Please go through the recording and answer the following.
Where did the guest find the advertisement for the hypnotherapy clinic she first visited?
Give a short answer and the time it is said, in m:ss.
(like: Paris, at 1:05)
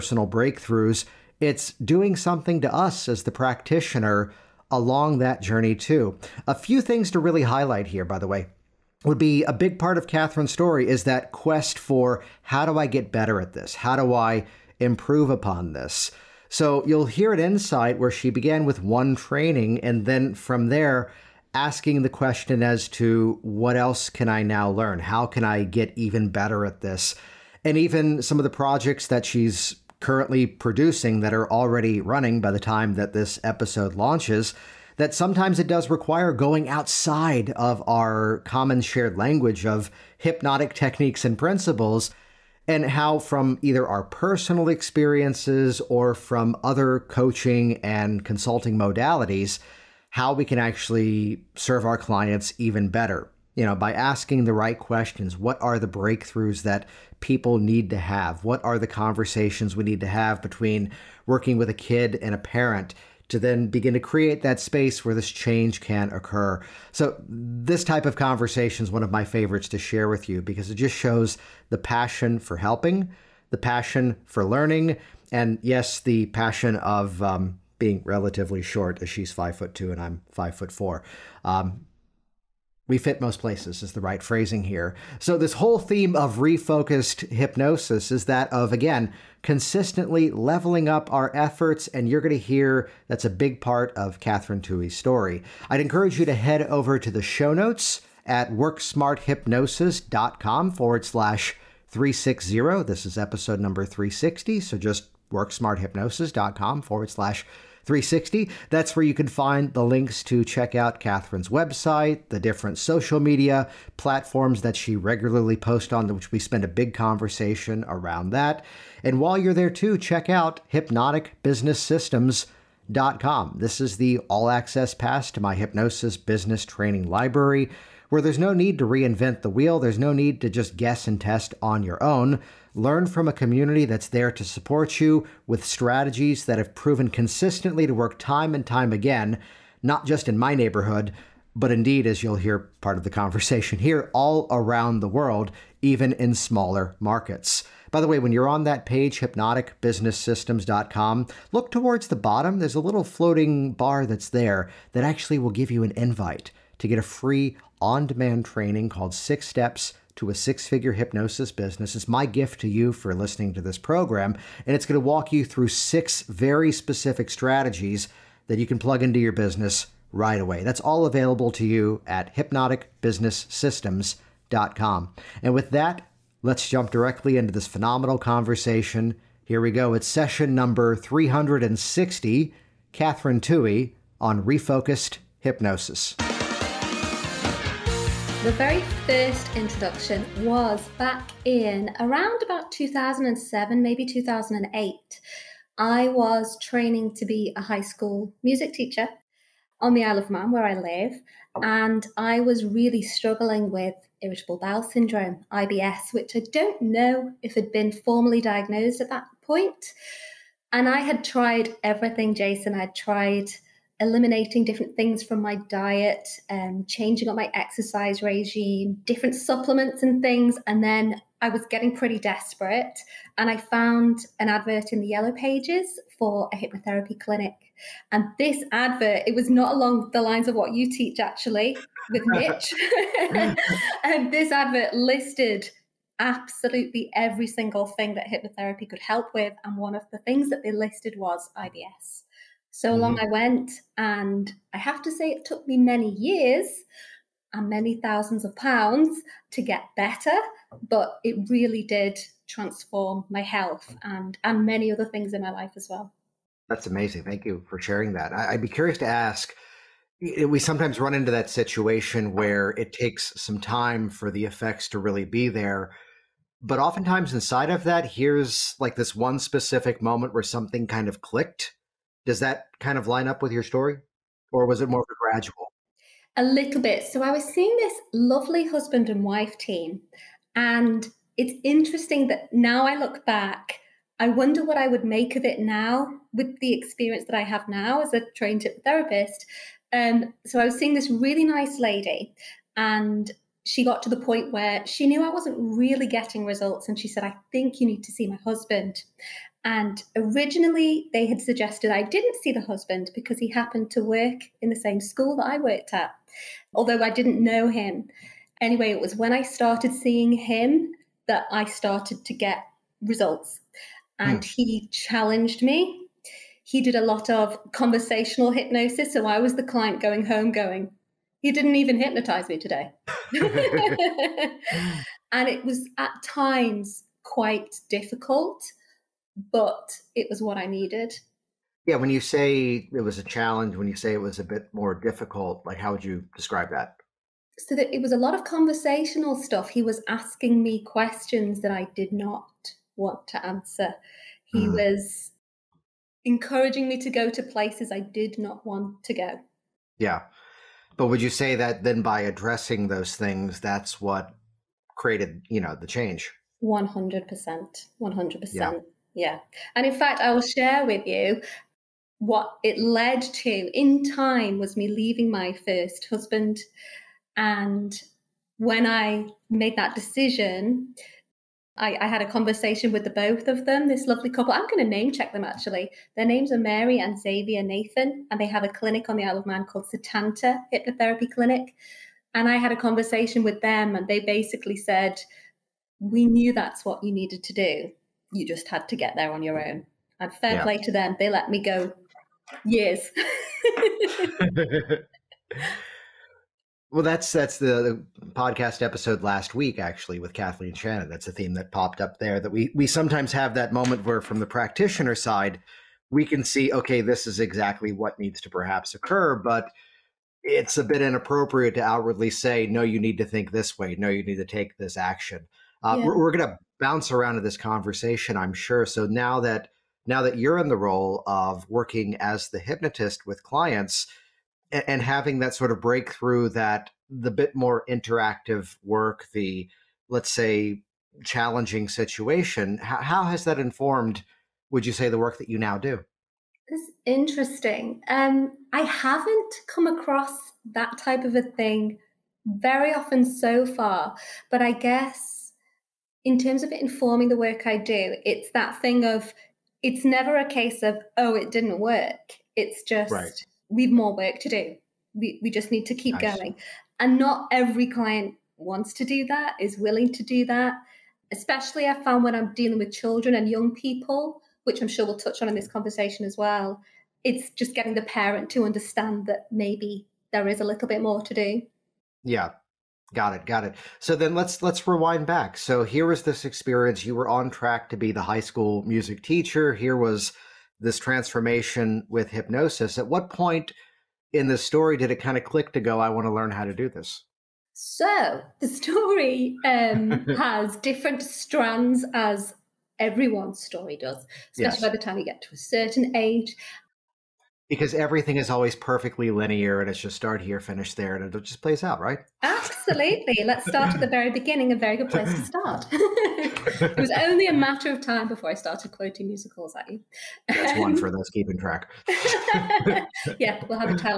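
Yellow pages, at 3:45.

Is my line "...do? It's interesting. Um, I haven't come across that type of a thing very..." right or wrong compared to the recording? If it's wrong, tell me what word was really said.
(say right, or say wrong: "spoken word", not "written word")
right.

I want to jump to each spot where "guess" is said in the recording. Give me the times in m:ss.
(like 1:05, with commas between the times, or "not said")
2:10, 7:24.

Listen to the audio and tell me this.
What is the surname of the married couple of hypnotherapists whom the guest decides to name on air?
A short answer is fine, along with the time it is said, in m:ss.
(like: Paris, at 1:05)
Nathan, at 6:17.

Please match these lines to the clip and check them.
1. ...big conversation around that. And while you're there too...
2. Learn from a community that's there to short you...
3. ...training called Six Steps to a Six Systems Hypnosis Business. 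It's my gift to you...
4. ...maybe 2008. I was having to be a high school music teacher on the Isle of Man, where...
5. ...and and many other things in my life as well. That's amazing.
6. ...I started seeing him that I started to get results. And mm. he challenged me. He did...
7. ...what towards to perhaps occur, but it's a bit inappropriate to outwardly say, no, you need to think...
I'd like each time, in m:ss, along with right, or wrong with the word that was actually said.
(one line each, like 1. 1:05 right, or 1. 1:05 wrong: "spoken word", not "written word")
1. 1:56 right
2. 2:12 wrong: "support", not "short"
3. 2:38 wrong: "Figure", not "Systems"
4. 3:13 wrong: "training", not "having"
5. 4:14 right
6. 5:09 right
7. 6:47 wrong: "needs", not "towards".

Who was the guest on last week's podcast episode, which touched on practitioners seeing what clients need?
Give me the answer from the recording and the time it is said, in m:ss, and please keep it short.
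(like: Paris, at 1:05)
Kathleen Shannon, at 6:40.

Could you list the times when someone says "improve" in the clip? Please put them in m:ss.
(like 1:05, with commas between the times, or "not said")
0:14.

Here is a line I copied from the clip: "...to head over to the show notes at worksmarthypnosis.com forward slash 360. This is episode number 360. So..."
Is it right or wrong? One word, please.
right.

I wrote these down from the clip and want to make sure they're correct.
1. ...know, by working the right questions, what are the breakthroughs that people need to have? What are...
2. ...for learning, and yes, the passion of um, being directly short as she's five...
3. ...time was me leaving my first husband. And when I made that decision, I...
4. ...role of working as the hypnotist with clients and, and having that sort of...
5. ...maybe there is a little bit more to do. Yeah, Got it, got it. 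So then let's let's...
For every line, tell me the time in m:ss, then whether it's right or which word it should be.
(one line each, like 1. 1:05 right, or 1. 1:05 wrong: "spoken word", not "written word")
1. 0:53 wrong: "asking", not "working"
2. 1:14 wrong: "relatively", not "directly"
3. 6:04 right
4. 7:00 right
5. 7:49 right.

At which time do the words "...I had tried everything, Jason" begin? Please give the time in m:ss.
3:30.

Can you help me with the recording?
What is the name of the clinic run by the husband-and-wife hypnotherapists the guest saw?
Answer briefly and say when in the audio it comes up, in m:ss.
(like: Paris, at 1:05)
Satanta Hypnotherapy Clinic, at 6:19.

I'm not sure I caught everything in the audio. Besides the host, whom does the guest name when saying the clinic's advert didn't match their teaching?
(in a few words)
Mitch.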